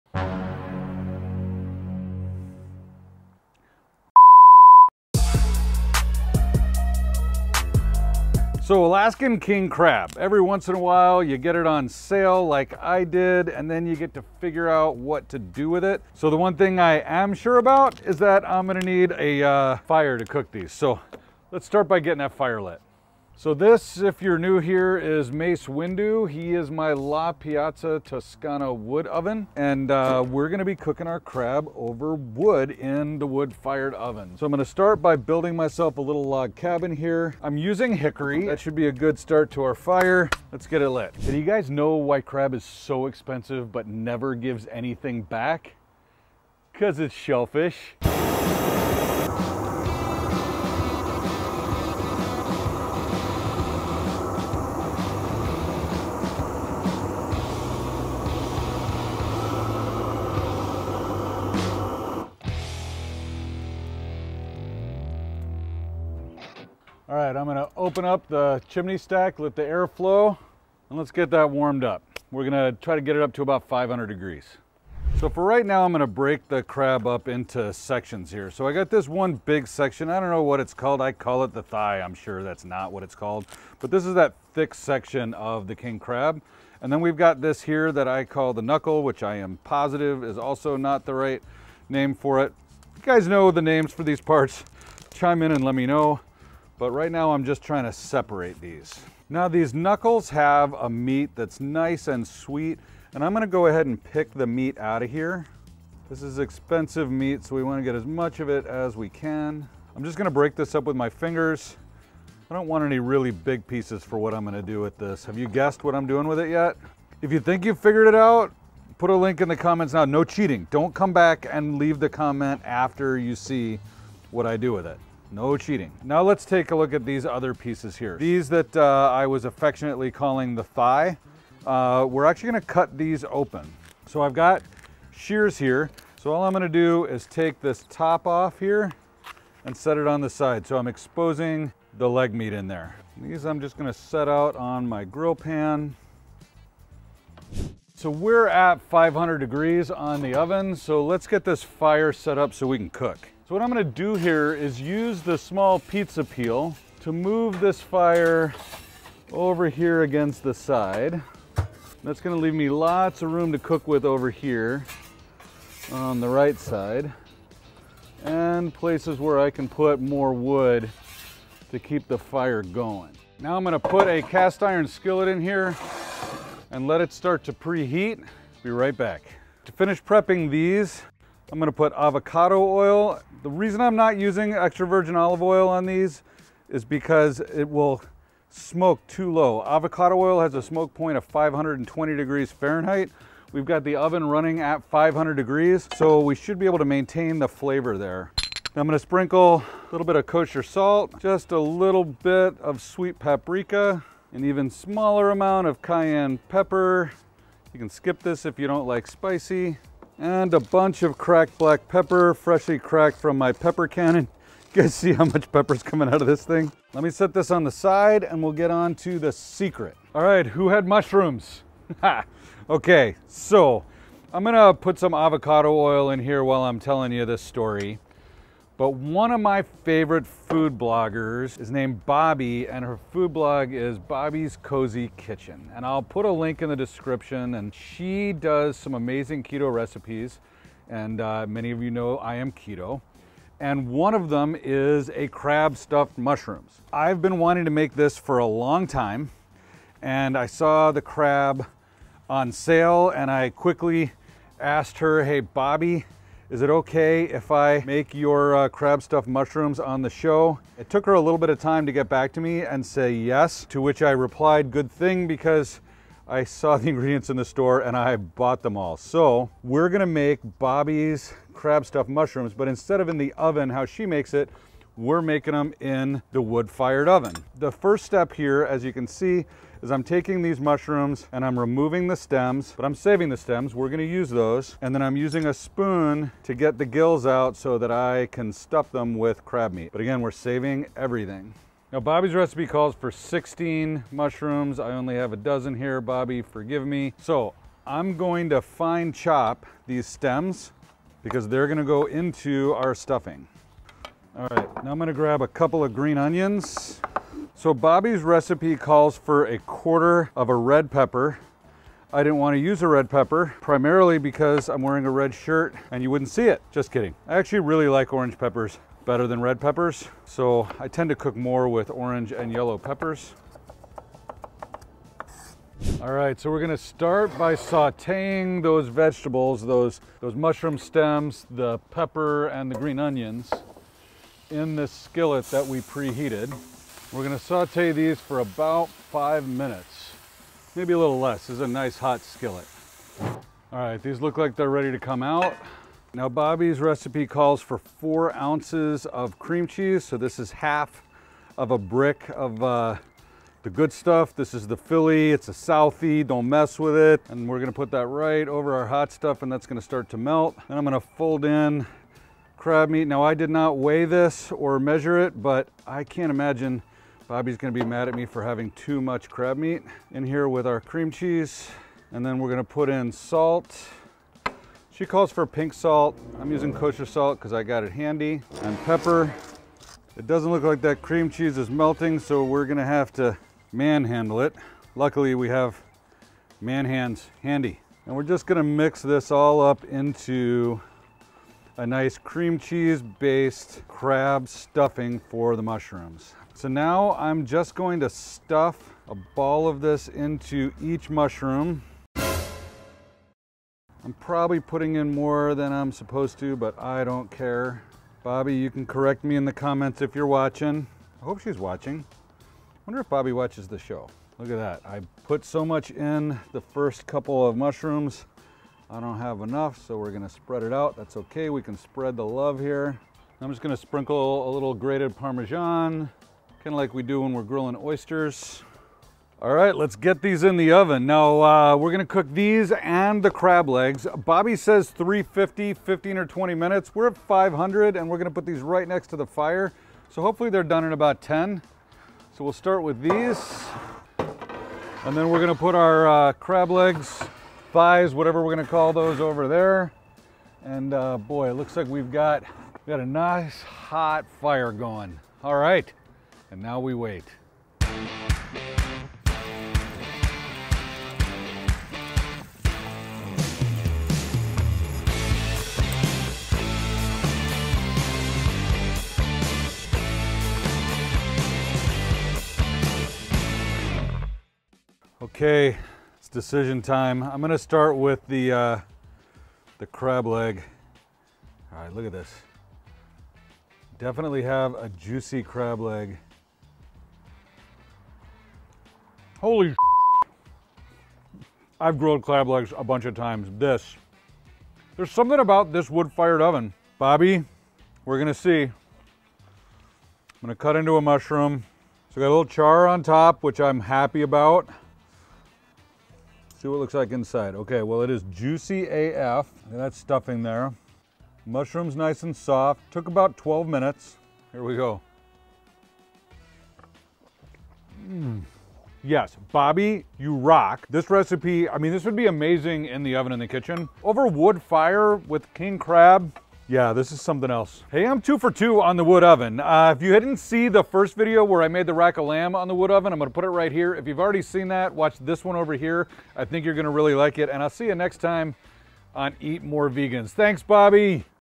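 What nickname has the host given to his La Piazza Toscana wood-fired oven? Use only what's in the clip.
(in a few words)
Mace Windu.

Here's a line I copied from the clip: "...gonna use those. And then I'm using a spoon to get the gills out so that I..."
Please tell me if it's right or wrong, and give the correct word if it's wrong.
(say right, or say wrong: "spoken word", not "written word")
right.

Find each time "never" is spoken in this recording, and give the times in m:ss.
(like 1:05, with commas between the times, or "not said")
0:43.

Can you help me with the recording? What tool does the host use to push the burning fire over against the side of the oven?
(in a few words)
Small pizza peel.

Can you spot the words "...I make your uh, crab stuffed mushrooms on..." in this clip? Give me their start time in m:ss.
4:17.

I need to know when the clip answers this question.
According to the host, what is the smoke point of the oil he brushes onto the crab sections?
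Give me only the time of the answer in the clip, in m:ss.
3:11.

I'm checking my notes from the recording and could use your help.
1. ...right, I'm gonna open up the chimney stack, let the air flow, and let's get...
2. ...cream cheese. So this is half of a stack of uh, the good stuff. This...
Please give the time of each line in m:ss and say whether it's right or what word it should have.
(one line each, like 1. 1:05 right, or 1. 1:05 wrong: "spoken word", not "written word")
1. 1:07 right
2. 5:49 wrong: "brick", not "stack".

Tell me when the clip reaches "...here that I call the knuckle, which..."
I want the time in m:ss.
1:27.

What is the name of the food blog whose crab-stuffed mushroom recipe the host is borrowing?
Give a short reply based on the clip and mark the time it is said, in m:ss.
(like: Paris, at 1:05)
Bobbi's Kozy Kitchen, at 3:53.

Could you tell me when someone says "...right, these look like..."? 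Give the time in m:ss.
5:43.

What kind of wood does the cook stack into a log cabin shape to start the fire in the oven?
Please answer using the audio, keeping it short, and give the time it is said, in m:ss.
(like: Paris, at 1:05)
Hickory, at 0:37.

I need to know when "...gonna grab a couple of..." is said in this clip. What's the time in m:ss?
5:04.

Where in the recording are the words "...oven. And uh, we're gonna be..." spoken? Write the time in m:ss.
0:29.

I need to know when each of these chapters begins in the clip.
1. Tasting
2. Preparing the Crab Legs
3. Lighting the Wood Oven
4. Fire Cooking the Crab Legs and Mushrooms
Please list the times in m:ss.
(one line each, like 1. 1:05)
1. 7:54
2. 1:15
3. 0:24
4. 7:12.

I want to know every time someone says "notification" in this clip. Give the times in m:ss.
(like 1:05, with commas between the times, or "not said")
not said.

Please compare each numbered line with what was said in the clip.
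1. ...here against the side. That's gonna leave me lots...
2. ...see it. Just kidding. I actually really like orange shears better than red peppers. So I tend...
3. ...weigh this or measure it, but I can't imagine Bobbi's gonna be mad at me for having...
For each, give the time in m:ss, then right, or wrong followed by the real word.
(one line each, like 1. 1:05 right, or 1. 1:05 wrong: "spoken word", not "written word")
1. 2:39 right
2. 5:16 wrong: "peppers", not "shears"
3. 6:03 right.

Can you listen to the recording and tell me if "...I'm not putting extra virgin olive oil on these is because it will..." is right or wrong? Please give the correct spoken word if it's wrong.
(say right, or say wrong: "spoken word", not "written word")
wrong: "using", not "putting".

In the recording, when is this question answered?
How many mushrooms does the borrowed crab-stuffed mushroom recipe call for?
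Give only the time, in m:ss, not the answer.
4:53.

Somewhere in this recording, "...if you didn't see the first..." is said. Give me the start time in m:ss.
8:49.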